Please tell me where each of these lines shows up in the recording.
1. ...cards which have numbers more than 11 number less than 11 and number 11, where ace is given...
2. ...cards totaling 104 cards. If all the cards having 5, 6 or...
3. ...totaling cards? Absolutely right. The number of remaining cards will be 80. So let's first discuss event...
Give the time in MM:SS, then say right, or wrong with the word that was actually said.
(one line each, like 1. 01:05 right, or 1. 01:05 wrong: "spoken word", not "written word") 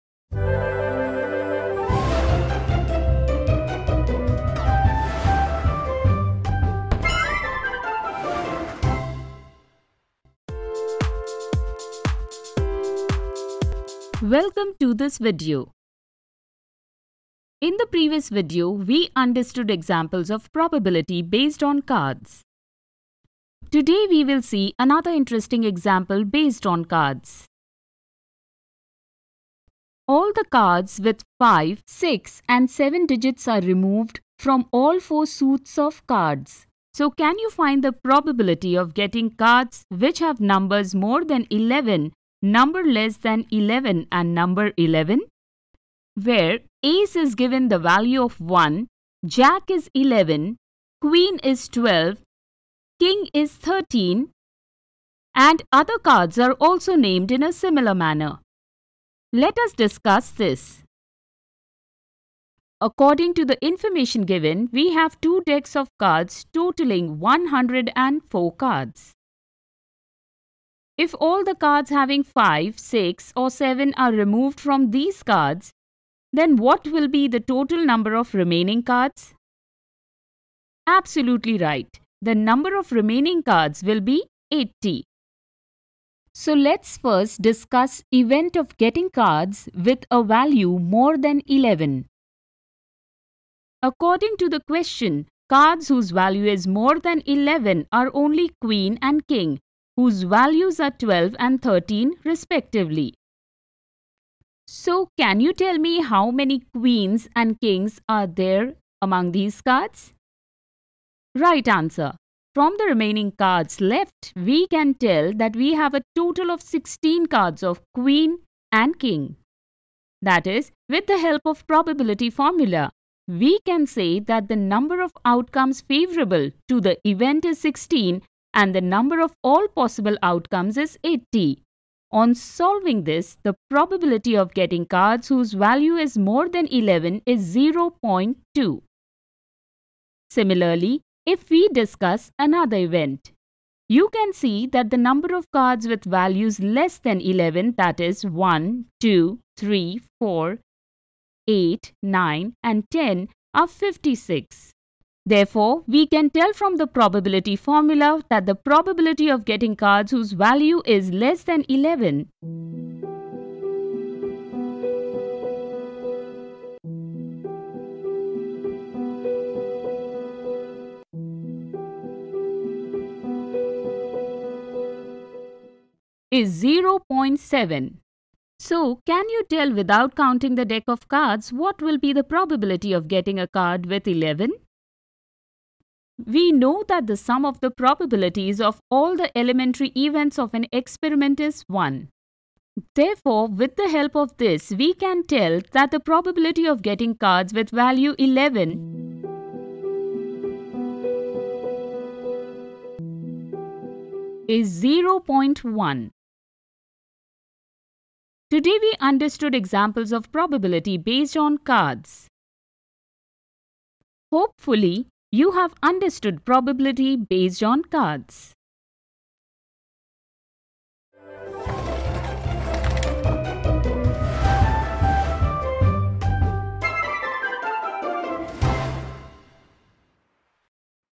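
1. 00:39 right
2. 01:05 right
3. 01:18 wrong: "remaining", not "totaling".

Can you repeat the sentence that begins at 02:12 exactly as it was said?
On solving this, the probability of getting cards whose value is more than 11 is 0.2.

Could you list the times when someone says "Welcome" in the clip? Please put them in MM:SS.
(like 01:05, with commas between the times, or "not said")
00:14.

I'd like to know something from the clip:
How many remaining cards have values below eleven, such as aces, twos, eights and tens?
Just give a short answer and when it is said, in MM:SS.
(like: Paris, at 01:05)
56, at 02:33.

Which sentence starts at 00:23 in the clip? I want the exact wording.
Today we will see another interesting example based on cards.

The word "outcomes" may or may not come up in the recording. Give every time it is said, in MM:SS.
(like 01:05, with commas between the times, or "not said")
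02:05, 02:10.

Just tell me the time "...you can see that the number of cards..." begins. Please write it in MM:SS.
02:23.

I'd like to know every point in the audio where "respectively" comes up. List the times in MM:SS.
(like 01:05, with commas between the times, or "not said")
01:42.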